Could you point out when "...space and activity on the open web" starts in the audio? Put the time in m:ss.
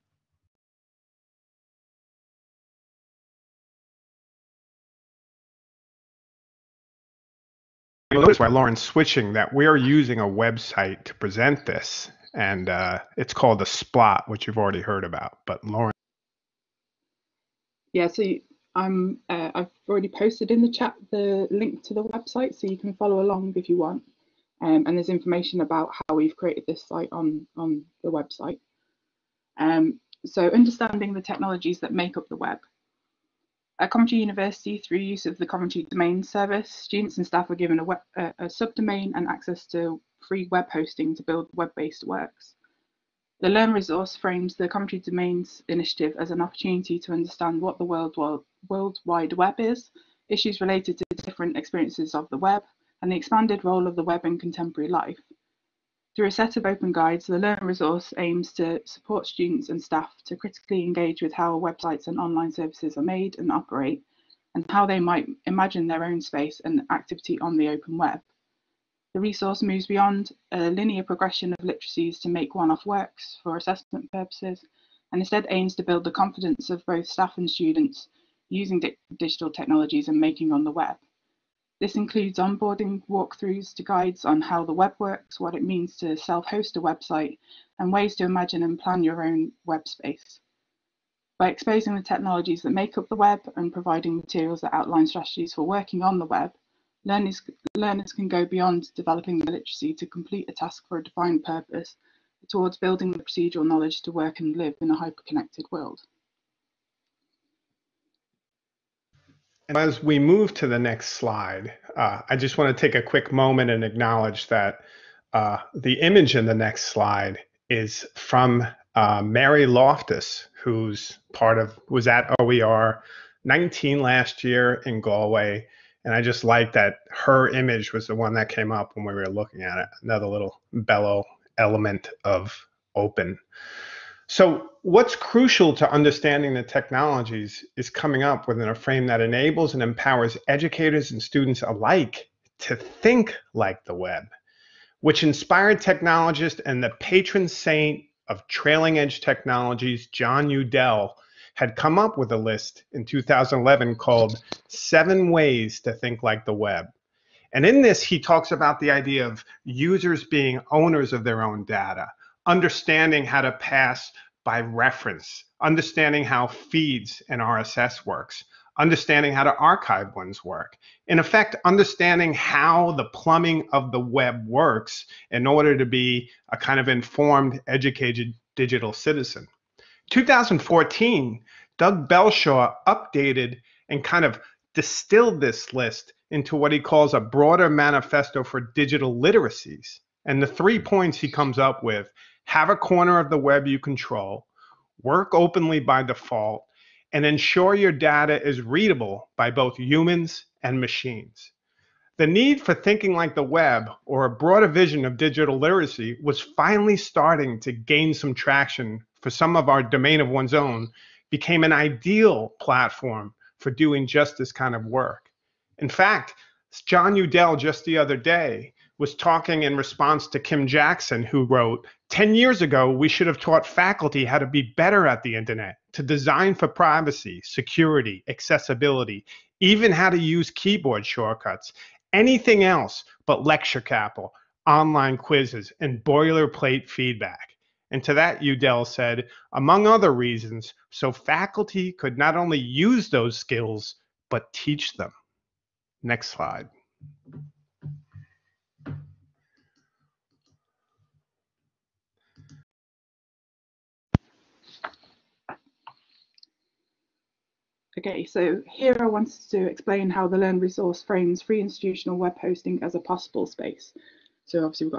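1:06.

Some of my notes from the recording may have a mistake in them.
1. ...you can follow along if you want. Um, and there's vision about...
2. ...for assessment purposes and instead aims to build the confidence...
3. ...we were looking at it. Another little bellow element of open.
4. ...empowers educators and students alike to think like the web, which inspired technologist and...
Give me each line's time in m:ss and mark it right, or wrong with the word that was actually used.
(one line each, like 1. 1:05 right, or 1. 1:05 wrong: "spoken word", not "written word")
1. 0:22 wrong: "information", not "vision"
2. 1:13 right
3. 2:09 right
4. 2:19 right.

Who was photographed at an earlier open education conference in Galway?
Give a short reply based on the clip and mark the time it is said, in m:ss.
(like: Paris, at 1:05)
Mary Loftus, at 1:59.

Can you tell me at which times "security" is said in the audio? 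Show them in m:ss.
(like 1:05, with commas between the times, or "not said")
3:47.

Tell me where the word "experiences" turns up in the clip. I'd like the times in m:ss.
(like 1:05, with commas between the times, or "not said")
0:51.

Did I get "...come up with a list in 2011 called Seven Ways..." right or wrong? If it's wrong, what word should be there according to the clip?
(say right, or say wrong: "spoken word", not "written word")
right.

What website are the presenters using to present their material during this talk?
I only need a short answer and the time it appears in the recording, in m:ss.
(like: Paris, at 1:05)
Splot, at 0:13.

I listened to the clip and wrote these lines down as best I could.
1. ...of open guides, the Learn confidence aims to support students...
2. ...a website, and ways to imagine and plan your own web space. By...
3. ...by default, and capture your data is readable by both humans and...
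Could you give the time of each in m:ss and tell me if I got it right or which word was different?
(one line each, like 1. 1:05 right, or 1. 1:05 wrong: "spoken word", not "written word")
1. 0:56 wrong: "resource", not "confidence"
2. 1:26 right
3. 3:15 wrong: "ensure", not "capture".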